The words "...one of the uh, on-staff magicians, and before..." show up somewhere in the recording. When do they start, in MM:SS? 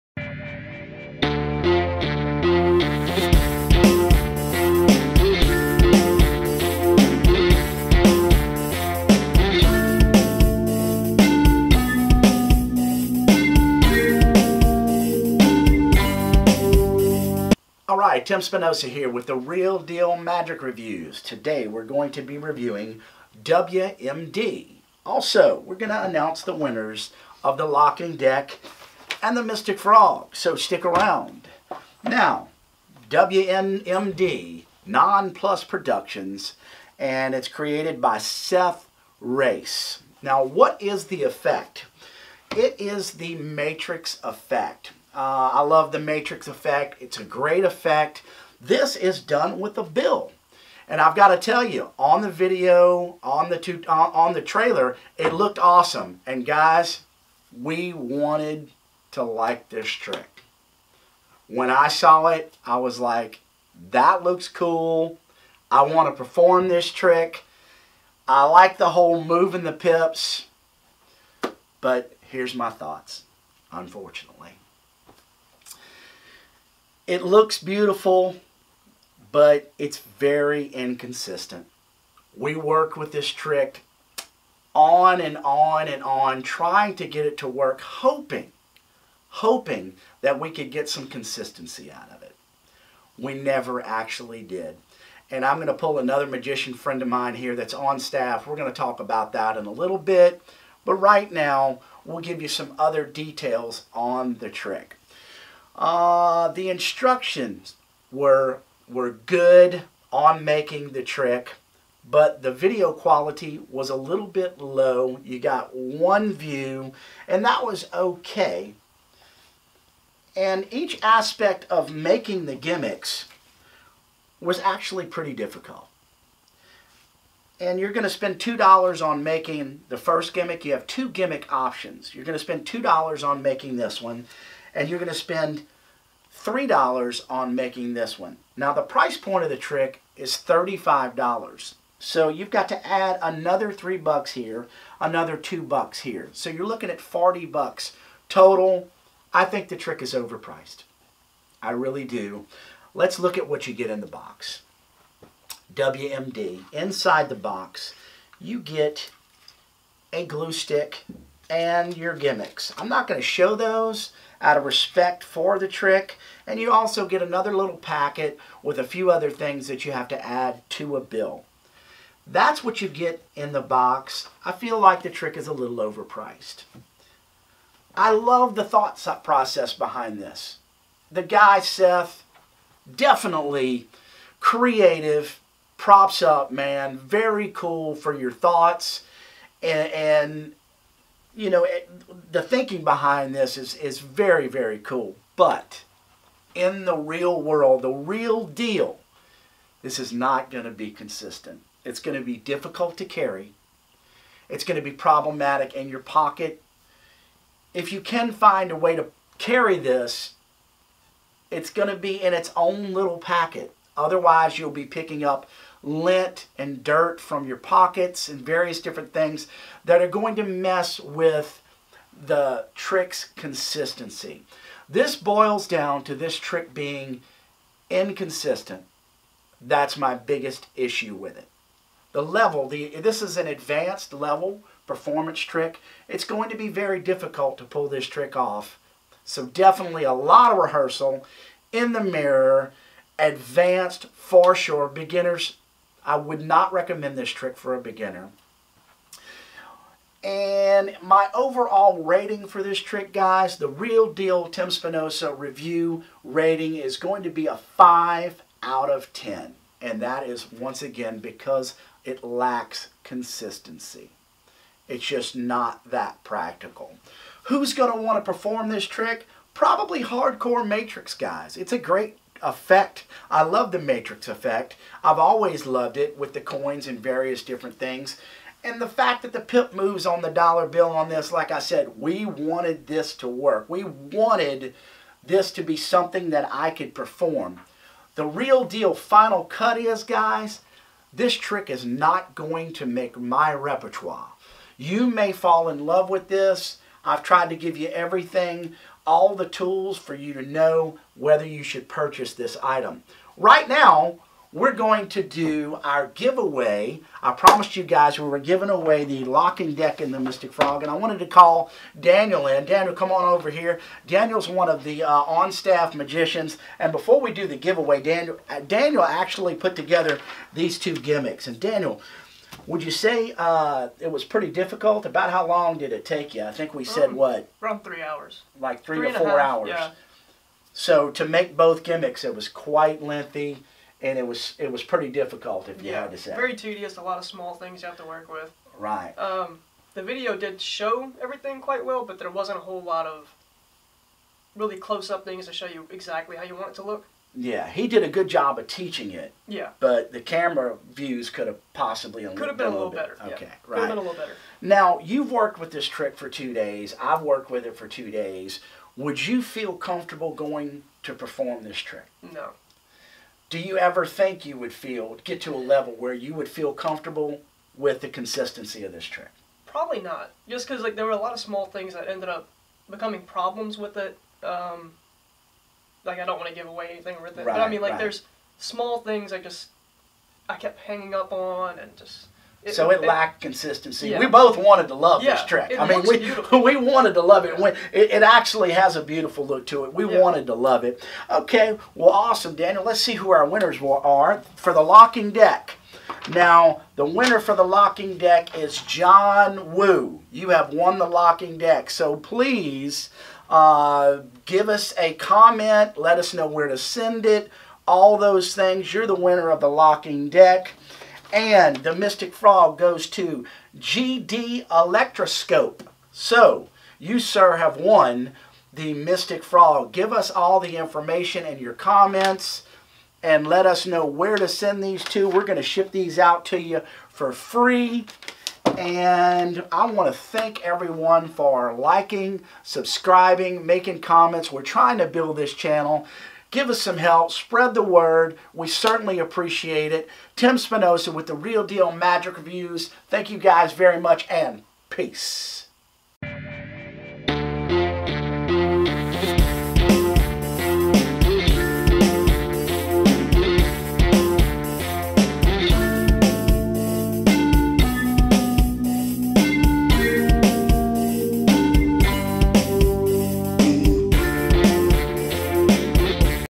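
05:14.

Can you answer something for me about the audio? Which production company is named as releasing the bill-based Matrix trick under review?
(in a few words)
Non Plus Productions.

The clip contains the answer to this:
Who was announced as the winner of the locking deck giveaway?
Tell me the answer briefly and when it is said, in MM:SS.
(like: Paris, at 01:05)
John Woo, at 06:38.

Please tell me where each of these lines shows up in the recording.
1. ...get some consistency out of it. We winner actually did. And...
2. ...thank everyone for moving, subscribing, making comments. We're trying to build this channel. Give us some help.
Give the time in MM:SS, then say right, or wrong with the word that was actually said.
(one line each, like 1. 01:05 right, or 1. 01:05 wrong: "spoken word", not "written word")
1. 01:30 wrong: "never", not "winner"
2. 07:10 wrong: "liking", not "moving".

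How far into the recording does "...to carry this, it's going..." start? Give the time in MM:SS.
03:28.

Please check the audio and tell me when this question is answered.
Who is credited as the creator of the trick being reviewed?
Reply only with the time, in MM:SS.
00:38.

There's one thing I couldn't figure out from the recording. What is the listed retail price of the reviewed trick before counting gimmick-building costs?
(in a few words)
$35.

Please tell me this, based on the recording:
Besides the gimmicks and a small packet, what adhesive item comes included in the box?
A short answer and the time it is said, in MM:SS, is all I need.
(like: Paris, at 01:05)
A glue stick, at 02:40.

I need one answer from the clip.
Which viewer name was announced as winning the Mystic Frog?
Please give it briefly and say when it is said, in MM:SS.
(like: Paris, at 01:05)
GD Electroscope, at 06:53.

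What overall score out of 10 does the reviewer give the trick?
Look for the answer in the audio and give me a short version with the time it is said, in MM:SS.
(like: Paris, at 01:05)
5, at 04:17.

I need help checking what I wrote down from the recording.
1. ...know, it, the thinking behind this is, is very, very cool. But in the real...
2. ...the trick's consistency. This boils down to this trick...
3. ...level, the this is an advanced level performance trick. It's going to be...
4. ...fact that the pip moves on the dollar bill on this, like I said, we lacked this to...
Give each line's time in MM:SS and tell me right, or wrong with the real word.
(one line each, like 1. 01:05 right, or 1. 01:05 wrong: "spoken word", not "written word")
1. 03:11 right
2. 03:42 right
3. 03:52 right
4. 04:38 wrong: "wanted", not "lacked".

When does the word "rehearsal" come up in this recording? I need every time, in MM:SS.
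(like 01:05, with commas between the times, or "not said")
04:00.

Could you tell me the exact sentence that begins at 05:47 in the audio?
Yeah, he did a good job of teaching it.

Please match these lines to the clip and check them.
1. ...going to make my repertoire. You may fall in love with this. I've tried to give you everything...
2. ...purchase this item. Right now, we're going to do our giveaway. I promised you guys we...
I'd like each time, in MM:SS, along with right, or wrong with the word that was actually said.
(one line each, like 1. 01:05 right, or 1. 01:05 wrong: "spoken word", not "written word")
1. 04:52 right
2. 05:01 right.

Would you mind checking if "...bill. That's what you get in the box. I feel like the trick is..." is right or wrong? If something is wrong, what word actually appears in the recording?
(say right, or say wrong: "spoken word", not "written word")
right.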